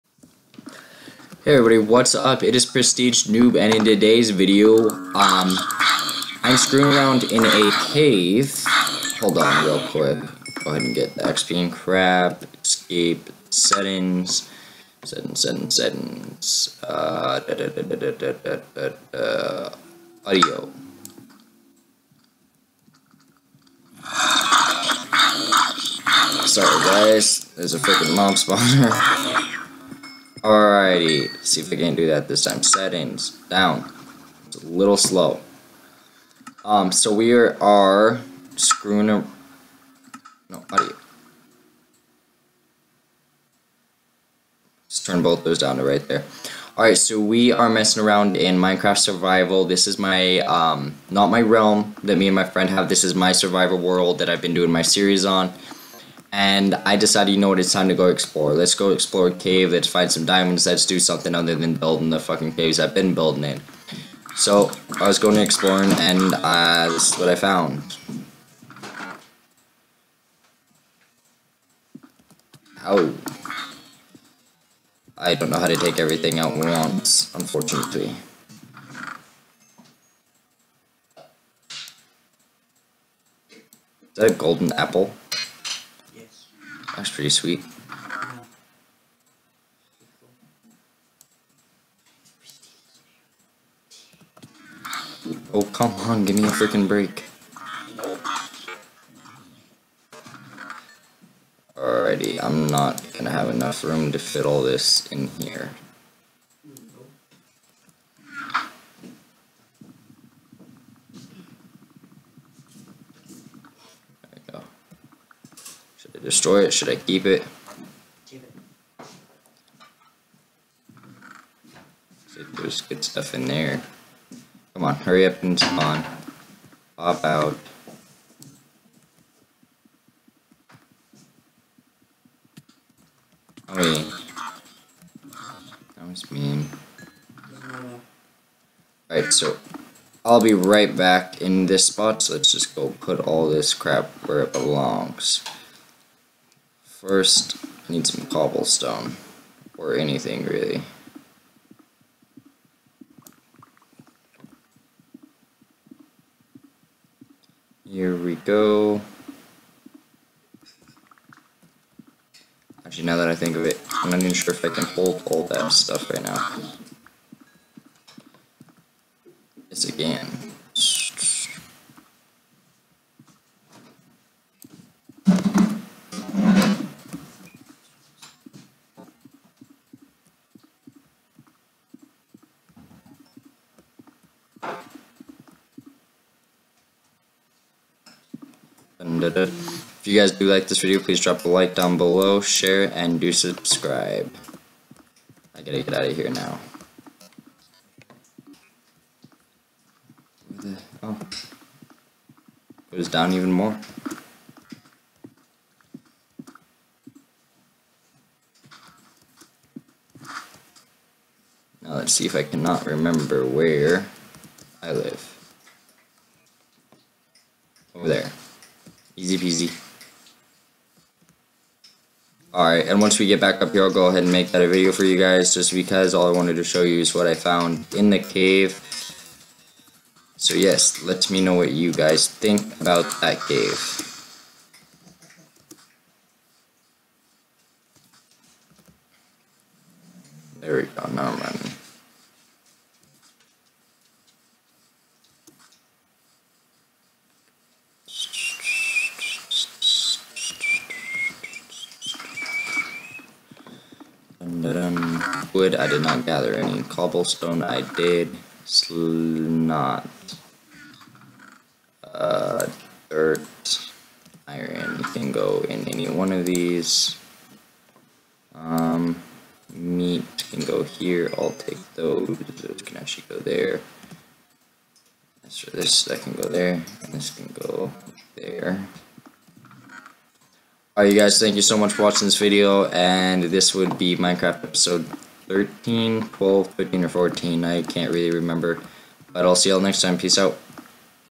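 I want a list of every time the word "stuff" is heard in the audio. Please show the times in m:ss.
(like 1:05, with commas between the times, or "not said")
2:03, 2:45.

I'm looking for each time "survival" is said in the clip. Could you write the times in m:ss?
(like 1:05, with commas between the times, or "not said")
0:48, 0:53.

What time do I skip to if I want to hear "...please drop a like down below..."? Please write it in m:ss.
3:10.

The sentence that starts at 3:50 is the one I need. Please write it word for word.
So yes, let me know what you guys think about that cave.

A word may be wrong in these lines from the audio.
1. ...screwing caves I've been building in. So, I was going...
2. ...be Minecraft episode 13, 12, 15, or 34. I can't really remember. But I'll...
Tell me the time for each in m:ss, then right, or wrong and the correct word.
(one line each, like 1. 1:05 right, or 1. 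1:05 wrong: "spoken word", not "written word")
1. 1:02 wrong: "fucking", not "screwing"
2. 4:43 wrong: "14", not "34".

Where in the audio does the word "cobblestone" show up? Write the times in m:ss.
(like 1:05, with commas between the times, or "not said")
2:28, 4:16.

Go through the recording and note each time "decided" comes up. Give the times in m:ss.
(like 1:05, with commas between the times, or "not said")
0:56.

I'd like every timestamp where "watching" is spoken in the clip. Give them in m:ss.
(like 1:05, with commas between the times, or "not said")
4:42.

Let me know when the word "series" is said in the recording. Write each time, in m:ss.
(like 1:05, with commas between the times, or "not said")
0:54.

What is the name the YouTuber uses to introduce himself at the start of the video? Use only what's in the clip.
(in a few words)
Prestige Noob.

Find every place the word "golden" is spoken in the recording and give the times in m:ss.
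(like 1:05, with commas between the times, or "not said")
1:24.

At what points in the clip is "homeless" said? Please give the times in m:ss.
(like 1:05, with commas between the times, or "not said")
not said.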